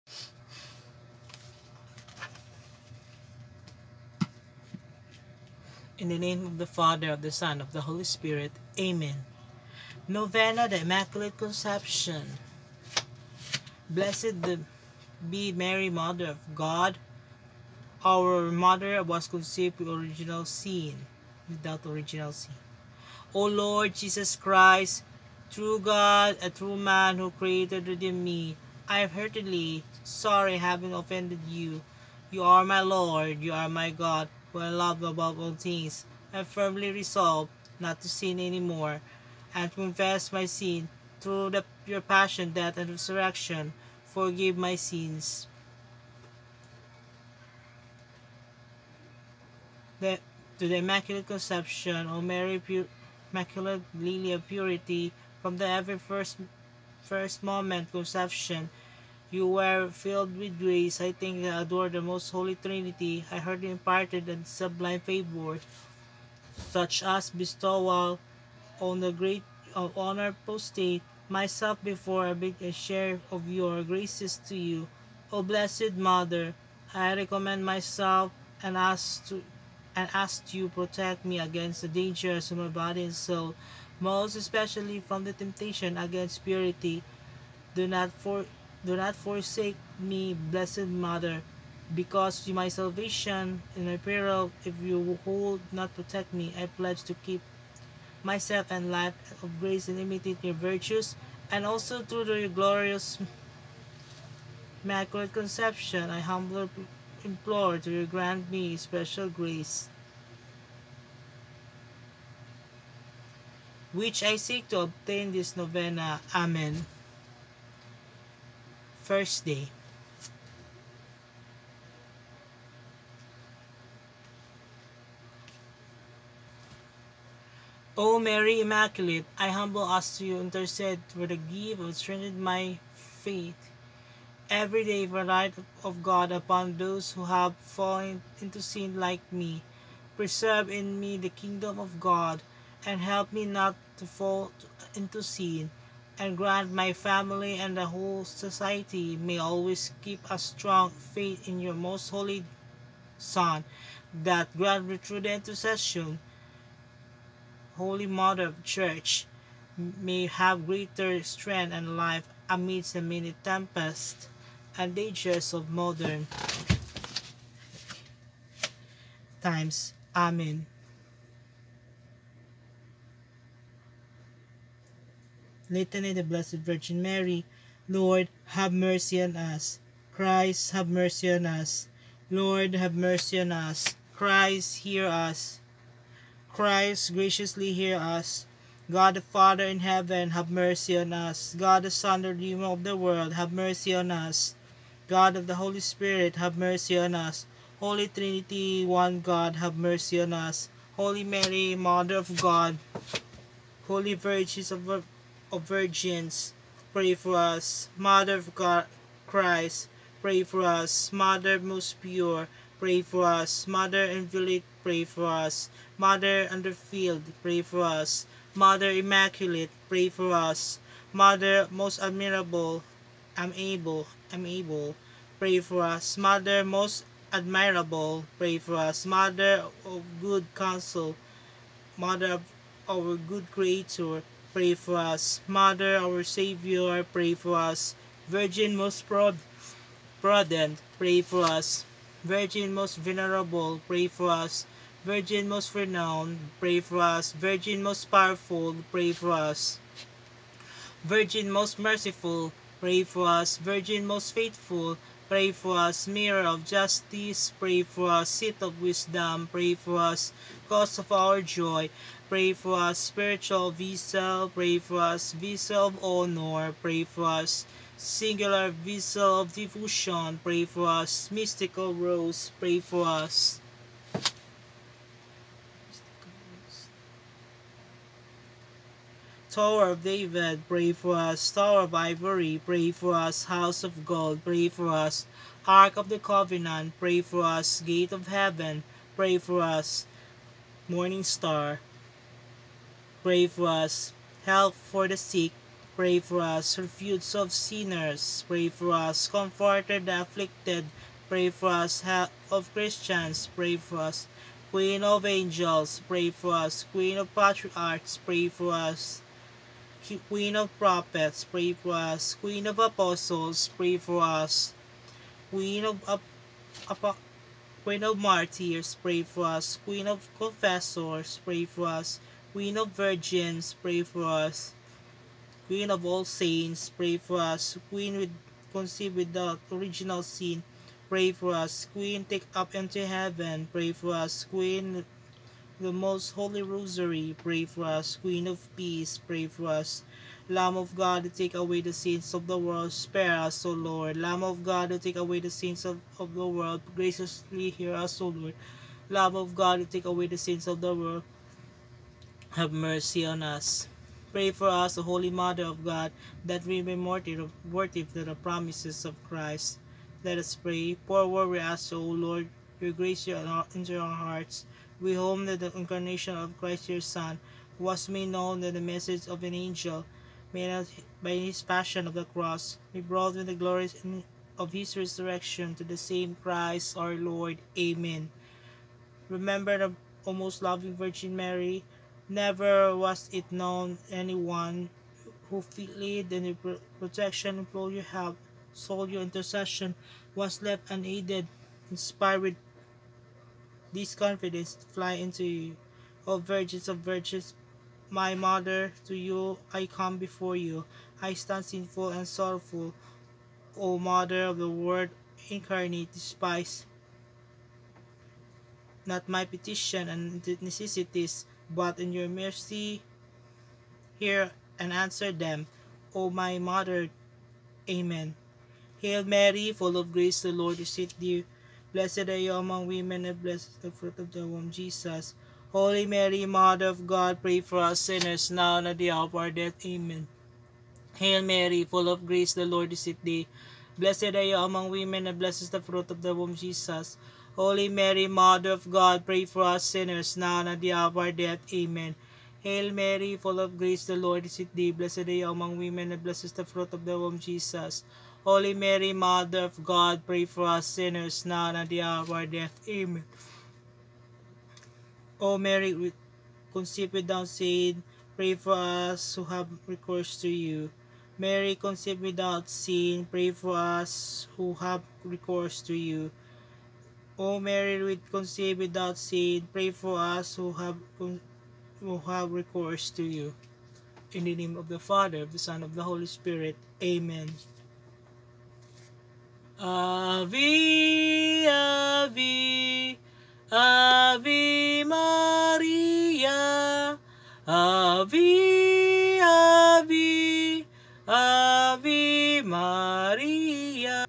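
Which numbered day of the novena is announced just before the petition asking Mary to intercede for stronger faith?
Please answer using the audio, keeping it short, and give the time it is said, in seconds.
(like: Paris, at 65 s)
First day, at 119 s.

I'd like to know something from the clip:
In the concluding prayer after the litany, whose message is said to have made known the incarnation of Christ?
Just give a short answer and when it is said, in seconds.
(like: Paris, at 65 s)
An angel, at 369 s.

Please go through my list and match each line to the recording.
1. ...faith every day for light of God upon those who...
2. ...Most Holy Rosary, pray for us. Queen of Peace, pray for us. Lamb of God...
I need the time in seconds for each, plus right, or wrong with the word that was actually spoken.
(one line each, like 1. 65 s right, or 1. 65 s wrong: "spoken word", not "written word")
1. 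132 s right
2. 335 s right.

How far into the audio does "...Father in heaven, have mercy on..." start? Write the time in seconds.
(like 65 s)
189 s.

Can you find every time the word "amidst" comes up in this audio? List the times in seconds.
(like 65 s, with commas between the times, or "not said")
162 s.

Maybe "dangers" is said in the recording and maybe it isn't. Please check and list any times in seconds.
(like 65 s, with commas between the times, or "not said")
81 s, 164 s.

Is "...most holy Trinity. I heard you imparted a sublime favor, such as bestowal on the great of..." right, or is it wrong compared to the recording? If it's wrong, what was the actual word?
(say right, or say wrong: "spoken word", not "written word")
right.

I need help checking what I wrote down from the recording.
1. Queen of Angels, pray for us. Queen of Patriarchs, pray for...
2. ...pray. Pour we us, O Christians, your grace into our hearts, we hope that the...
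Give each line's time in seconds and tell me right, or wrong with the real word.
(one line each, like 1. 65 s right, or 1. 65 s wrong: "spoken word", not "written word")
1. 304 s right
2. 360 s wrong: "Lord", not "Christians".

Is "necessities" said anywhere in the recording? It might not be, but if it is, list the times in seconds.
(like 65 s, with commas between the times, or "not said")
410 s.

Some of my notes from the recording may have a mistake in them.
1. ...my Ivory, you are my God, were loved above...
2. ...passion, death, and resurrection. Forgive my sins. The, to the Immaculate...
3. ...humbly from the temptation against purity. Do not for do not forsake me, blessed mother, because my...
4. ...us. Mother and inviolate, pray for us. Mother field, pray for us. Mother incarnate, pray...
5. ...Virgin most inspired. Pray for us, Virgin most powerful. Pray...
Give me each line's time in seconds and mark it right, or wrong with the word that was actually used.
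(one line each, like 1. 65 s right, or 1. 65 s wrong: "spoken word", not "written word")
1. 32 s wrong: "Lord", not "Ivory"
2. 42 s right
3. 84 s wrong: "especially", not "humbly"
4. 213 s wrong: "immaculate", not "incarnate"
5. 245 s wrong: "renowned", not "inspired".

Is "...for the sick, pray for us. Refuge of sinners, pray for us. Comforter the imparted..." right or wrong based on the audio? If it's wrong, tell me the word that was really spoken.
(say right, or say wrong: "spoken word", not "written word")
wrong: "afflicted", not "imparted".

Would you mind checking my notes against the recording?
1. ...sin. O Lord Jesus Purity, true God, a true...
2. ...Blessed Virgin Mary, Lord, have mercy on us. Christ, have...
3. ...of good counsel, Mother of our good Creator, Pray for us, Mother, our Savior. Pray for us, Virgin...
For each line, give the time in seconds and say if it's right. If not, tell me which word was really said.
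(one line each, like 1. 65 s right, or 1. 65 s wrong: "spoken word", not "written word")
1. 22 s wrong: "Christ", not "Purity"
2. 176 s right
3. 229 s right.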